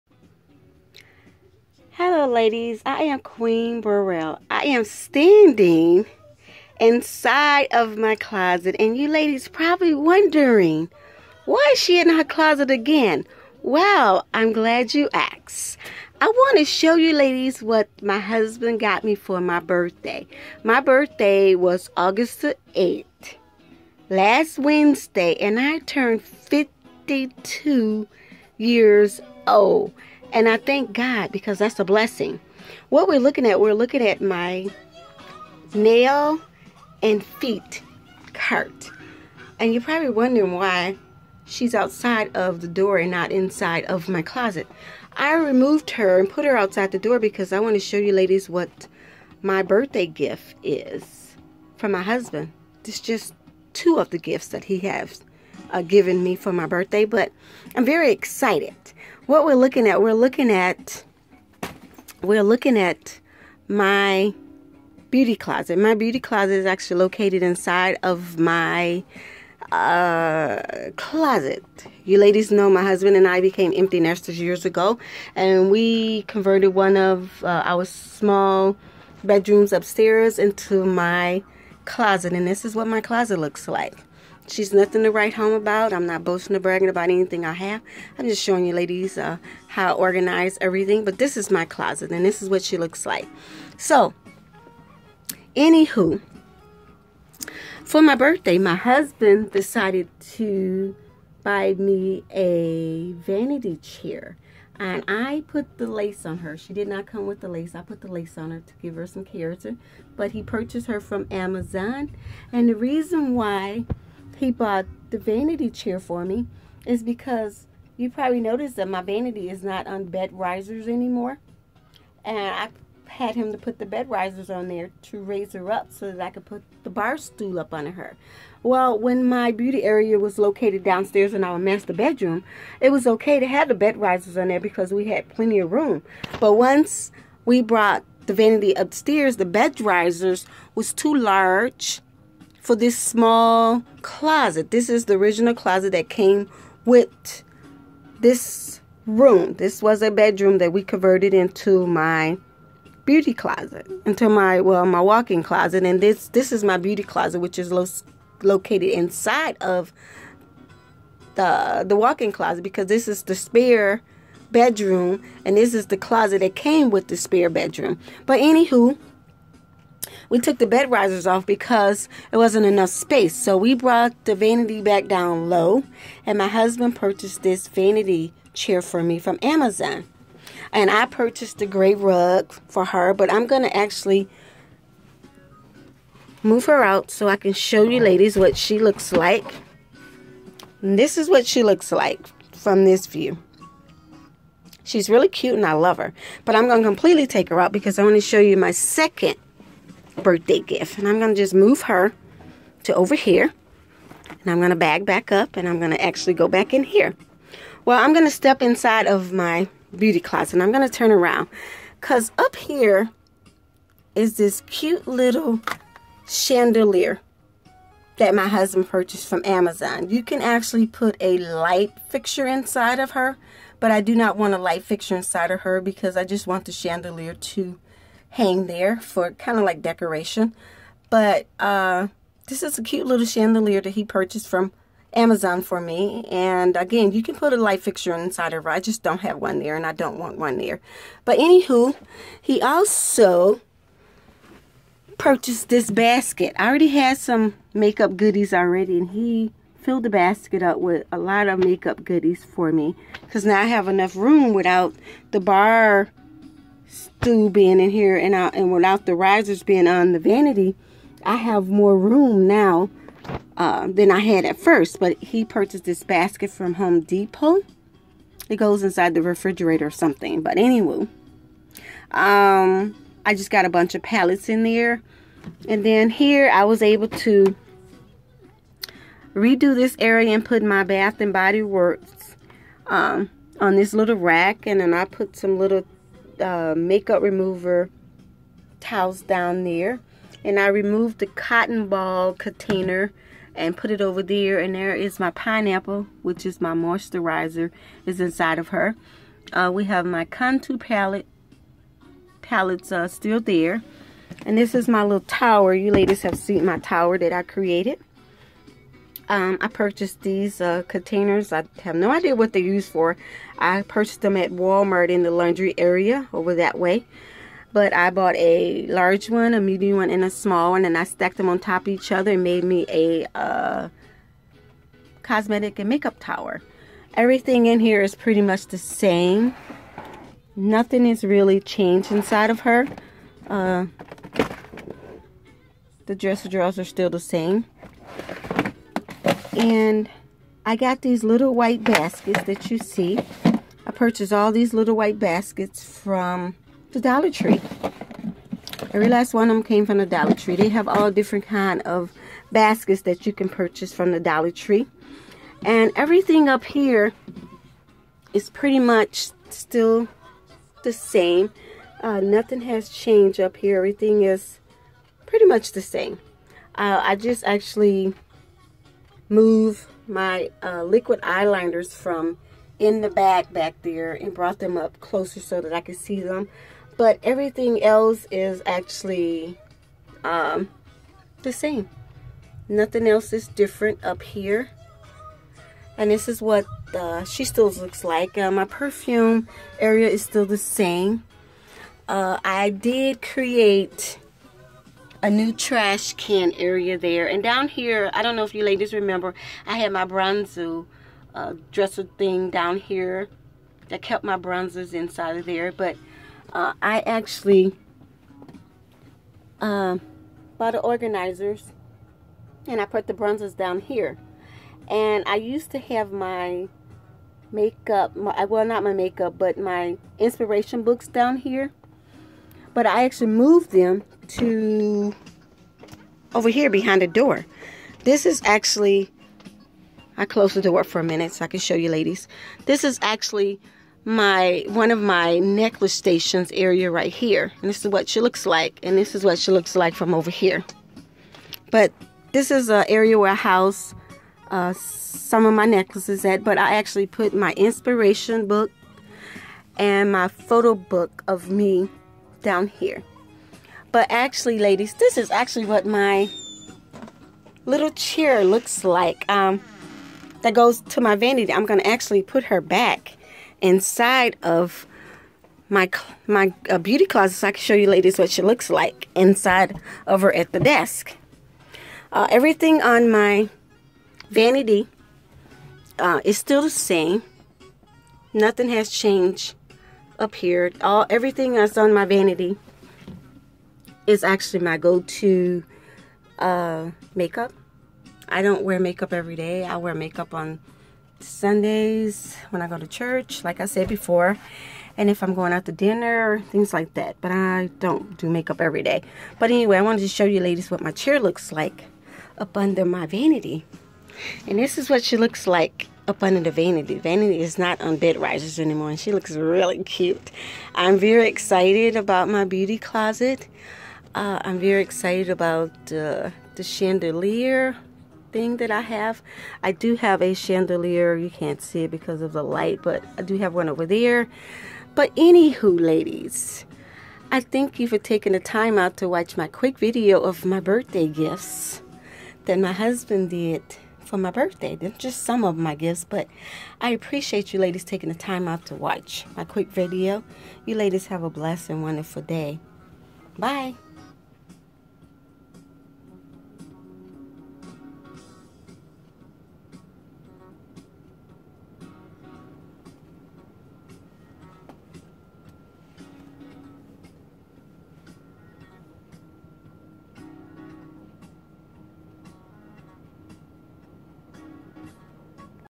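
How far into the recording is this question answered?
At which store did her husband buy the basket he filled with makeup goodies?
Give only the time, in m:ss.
4:26.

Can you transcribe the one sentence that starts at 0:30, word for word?
And I thank God because that's a blessing.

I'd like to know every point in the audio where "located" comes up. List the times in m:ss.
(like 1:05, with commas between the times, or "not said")
1:06, 2:10, 2:38.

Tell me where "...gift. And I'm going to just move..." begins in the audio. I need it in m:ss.
3:20.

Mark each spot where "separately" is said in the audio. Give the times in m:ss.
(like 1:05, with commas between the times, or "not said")
not said.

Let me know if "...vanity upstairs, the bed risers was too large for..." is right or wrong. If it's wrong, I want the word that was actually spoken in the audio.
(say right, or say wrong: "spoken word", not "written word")
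right.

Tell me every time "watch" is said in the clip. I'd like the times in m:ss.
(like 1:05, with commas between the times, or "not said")
8:49, 8:58.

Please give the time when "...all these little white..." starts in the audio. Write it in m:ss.
5:44.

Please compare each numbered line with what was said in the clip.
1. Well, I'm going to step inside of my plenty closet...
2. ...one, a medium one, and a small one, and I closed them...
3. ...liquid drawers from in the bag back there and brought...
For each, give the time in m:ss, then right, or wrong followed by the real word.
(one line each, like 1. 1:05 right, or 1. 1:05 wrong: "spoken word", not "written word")
1. 3:27 wrong: "beauty", not "plenty"
2. 5:19 wrong: "stacked", not "closed"
3. 6:10 wrong: "eyeliners", not "drawers".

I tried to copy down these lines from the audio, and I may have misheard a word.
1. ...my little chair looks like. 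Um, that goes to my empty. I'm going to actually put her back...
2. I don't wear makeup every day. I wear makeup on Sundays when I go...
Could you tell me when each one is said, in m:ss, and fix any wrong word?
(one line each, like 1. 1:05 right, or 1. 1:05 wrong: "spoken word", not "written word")
1. 7:35 wrong: "vanity", not "empty"
2. 8:08 right.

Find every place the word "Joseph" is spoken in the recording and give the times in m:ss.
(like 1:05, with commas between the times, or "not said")
not said.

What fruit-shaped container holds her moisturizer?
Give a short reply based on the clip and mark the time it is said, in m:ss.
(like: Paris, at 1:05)
Pineapple, at 4:55.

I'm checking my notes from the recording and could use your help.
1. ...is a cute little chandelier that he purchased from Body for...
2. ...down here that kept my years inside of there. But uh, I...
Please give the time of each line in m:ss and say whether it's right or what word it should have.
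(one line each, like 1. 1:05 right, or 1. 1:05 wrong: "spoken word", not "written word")
1. 3:52 wrong: "Amazon", not "Body"
2. 6:42 wrong: "bronzers", not "years".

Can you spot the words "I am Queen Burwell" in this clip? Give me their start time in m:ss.
0:02.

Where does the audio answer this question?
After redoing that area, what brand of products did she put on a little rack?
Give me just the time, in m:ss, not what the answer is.
4:40.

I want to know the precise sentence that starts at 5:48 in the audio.
I realized one of them came from the Dollar Tree.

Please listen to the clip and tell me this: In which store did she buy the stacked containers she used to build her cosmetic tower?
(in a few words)
Walmart.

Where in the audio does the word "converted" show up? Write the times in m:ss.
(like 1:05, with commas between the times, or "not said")
1:16, 2:30.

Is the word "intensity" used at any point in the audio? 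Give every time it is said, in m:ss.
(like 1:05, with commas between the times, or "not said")
not said.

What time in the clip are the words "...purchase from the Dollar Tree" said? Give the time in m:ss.
5:53.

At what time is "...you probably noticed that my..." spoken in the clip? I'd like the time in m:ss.
1:57.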